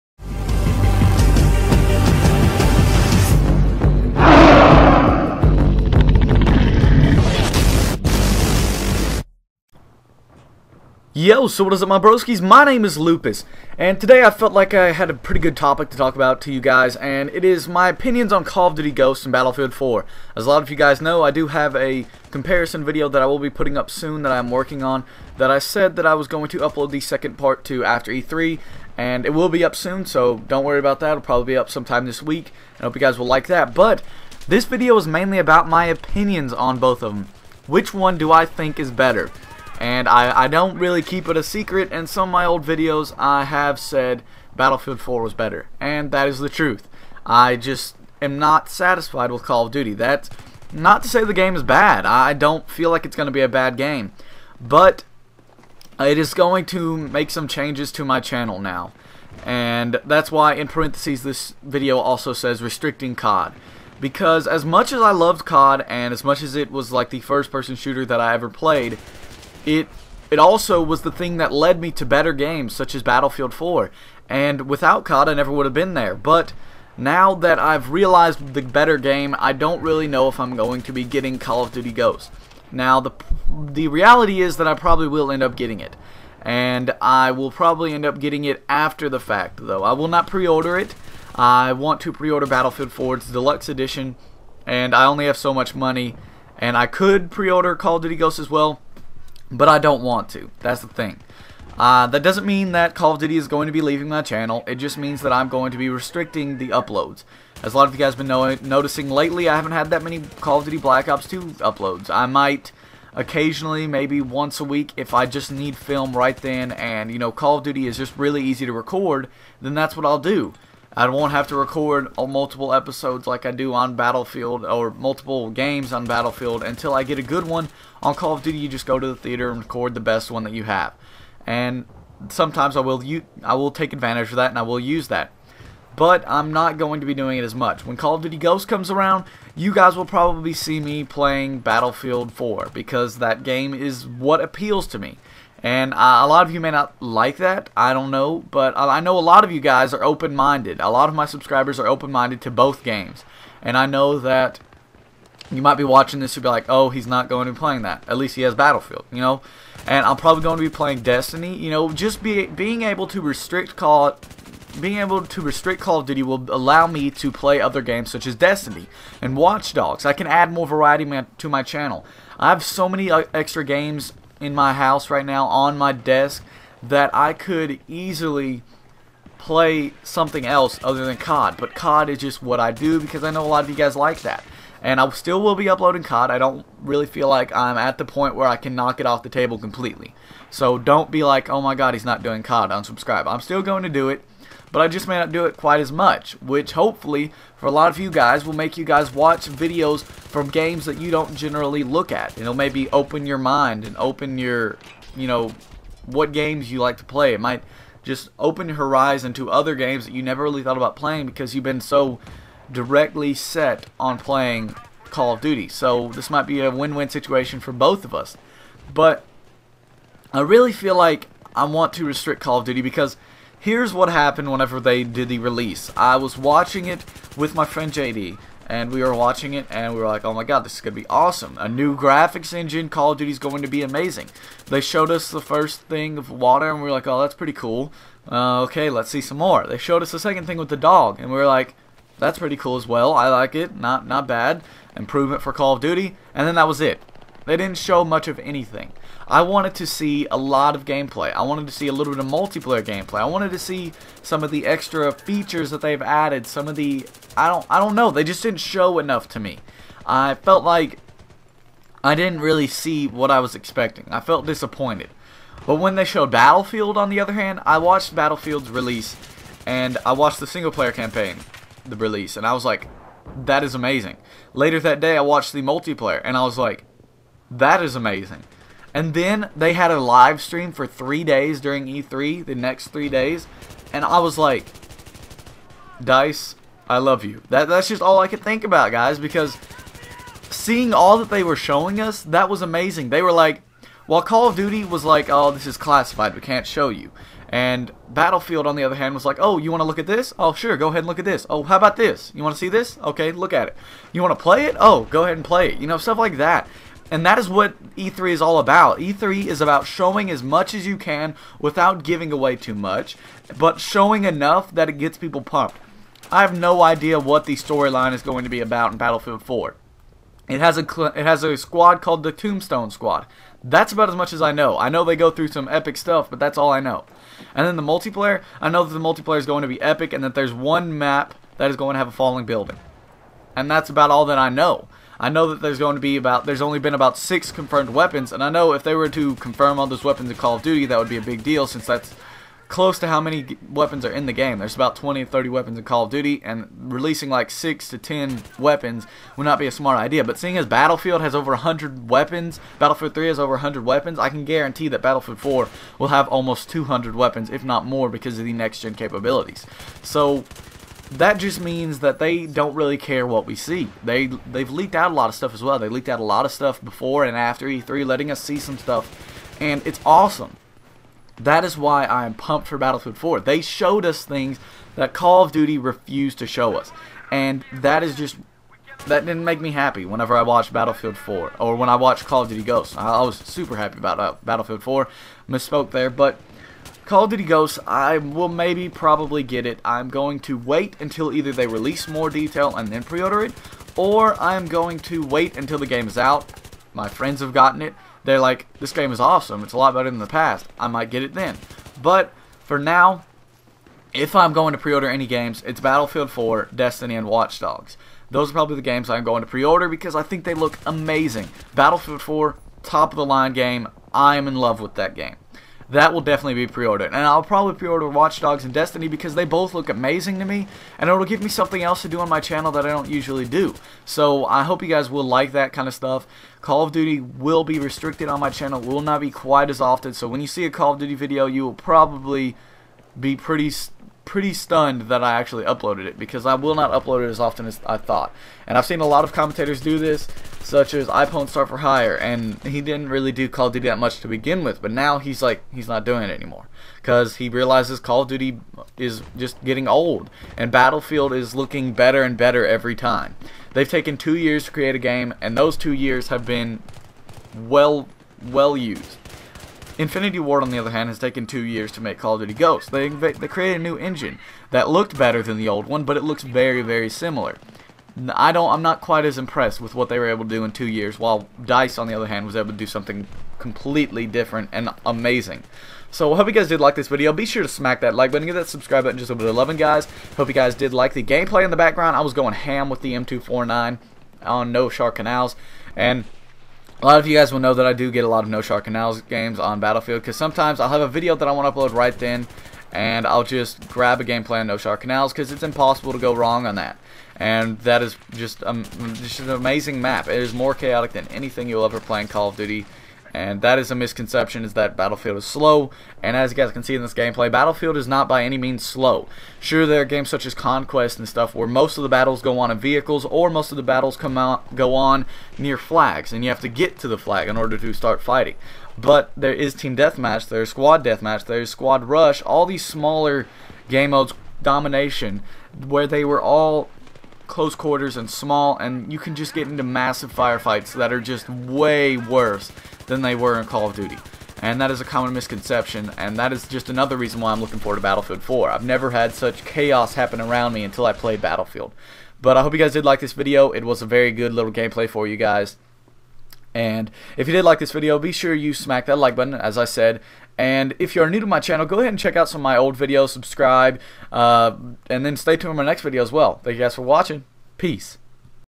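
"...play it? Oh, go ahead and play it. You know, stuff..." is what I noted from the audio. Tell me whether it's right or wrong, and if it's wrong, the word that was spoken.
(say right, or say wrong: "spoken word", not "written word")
right.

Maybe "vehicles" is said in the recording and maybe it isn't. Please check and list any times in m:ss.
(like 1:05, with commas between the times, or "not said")
8:32.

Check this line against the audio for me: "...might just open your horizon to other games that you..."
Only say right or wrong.
right.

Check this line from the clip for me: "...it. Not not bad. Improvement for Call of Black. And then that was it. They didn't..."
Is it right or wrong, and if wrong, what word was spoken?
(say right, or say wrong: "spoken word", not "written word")
wrong: "Duty", not "Black".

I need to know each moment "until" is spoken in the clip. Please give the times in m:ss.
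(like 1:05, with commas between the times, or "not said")
2:06, 6:30, 6:35, 9:00.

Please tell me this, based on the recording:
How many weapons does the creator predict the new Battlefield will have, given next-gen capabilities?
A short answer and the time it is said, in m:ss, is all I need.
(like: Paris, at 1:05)
almost 200, at 5:56.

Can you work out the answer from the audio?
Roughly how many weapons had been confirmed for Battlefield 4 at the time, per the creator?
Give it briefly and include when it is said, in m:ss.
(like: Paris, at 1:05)
6, at 5:37.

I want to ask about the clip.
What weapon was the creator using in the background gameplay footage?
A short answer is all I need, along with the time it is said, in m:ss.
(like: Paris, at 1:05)
M249, at 8:03.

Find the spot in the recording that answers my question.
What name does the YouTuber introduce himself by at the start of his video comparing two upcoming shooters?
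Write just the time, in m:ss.
0:12.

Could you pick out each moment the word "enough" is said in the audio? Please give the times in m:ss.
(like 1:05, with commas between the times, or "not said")
4:18, 5:14.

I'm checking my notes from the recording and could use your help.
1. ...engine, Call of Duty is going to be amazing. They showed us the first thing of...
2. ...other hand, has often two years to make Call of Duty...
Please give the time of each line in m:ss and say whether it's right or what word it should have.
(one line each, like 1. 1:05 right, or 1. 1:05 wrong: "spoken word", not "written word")
1. 3:52 right
2. 7:40 wrong: "taken", not "often".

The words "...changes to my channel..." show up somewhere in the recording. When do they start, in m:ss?
0:57.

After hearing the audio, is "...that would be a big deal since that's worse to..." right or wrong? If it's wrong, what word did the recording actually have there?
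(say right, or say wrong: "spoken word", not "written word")
wrong: "close", not "worse".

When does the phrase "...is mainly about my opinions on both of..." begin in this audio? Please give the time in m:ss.
0:34.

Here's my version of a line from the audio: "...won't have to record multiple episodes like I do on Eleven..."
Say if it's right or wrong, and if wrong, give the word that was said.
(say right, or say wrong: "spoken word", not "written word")
wrong: "Battlefield", not "Eleven".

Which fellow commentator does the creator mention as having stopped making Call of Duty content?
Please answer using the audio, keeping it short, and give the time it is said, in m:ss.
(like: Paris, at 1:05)
iPwnStar4Hire, at 7:21.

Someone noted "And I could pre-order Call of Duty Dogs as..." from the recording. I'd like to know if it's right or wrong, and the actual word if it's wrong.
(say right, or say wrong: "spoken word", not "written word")
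wrong: "Ghosts", not "Dogs".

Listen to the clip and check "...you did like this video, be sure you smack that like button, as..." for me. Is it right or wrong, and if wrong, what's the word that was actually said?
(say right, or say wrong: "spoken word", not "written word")
right.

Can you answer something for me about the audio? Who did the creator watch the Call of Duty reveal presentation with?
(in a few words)
JD.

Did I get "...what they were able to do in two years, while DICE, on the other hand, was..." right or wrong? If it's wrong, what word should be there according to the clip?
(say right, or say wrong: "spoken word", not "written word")
right.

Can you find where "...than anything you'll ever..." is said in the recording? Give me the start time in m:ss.
8:21.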